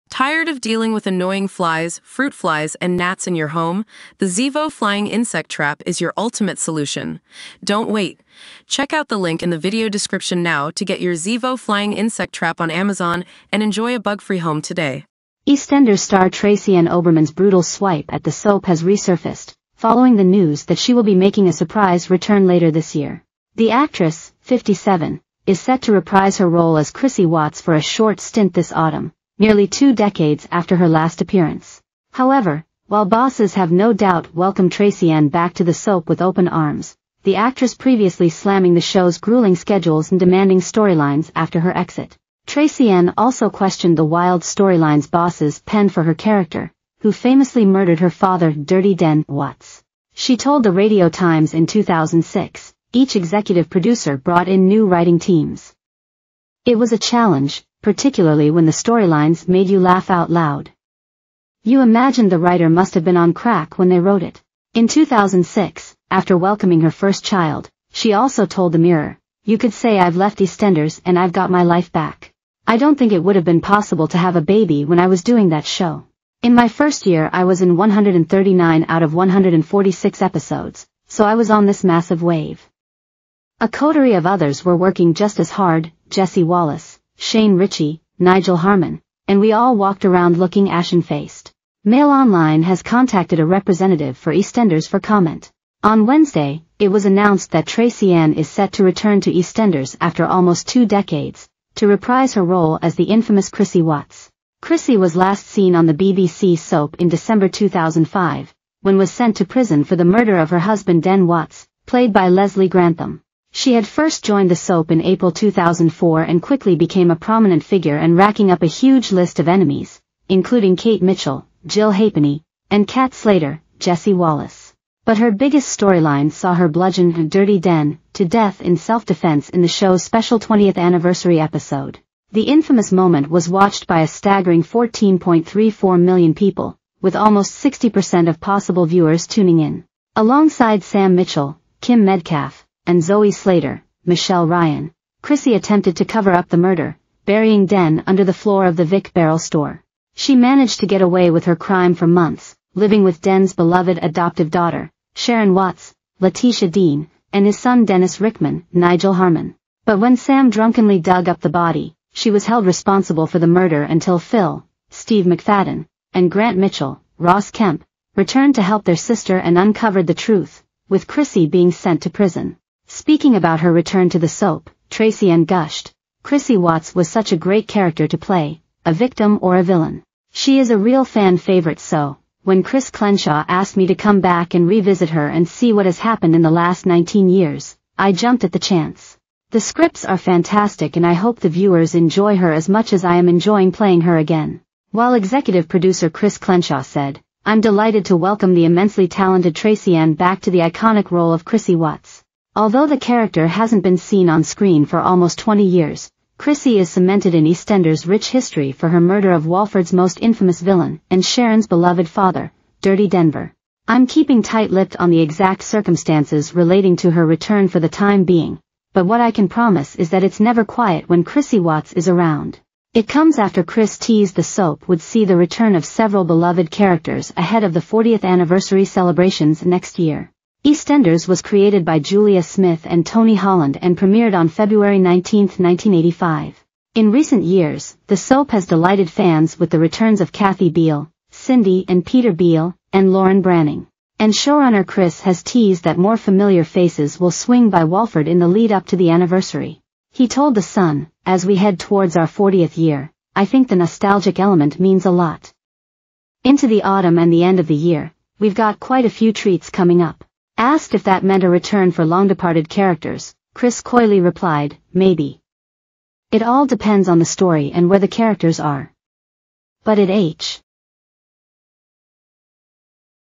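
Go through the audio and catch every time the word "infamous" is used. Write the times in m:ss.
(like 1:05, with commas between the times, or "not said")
1:43, 2:12, 3:30.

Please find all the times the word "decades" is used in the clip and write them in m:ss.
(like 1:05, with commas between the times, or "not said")
0:29, 1:40.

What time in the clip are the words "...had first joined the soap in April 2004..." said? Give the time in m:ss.
1:53.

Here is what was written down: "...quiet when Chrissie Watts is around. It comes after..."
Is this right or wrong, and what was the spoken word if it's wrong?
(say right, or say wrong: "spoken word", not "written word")
right.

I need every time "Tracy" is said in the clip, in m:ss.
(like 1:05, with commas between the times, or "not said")
0:16, 0:34, 0:42, 1:37, 2:54, 3:19.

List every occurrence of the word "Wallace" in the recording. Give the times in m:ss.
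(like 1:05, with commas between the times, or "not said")
1:26, 2:04.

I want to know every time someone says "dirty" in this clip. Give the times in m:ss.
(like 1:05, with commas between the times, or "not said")
0:48, 2:07, 3:32.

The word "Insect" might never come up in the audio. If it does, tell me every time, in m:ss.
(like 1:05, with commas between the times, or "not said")
0:05, 0:11.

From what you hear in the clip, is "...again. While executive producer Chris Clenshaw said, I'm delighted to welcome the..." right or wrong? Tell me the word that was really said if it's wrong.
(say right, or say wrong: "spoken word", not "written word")
right.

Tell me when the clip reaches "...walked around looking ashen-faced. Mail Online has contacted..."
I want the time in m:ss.
1:29.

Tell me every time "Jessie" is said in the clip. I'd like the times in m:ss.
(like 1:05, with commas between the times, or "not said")
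1:26, 2:03.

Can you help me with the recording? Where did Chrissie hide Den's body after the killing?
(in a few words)
Vic Barrel store.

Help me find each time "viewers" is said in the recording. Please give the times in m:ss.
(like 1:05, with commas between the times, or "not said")
2:18, 3:11.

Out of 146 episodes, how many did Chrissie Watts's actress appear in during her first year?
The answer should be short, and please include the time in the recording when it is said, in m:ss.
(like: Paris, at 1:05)
139, at 1:17.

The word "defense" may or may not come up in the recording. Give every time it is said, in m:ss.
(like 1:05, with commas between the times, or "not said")
2:08.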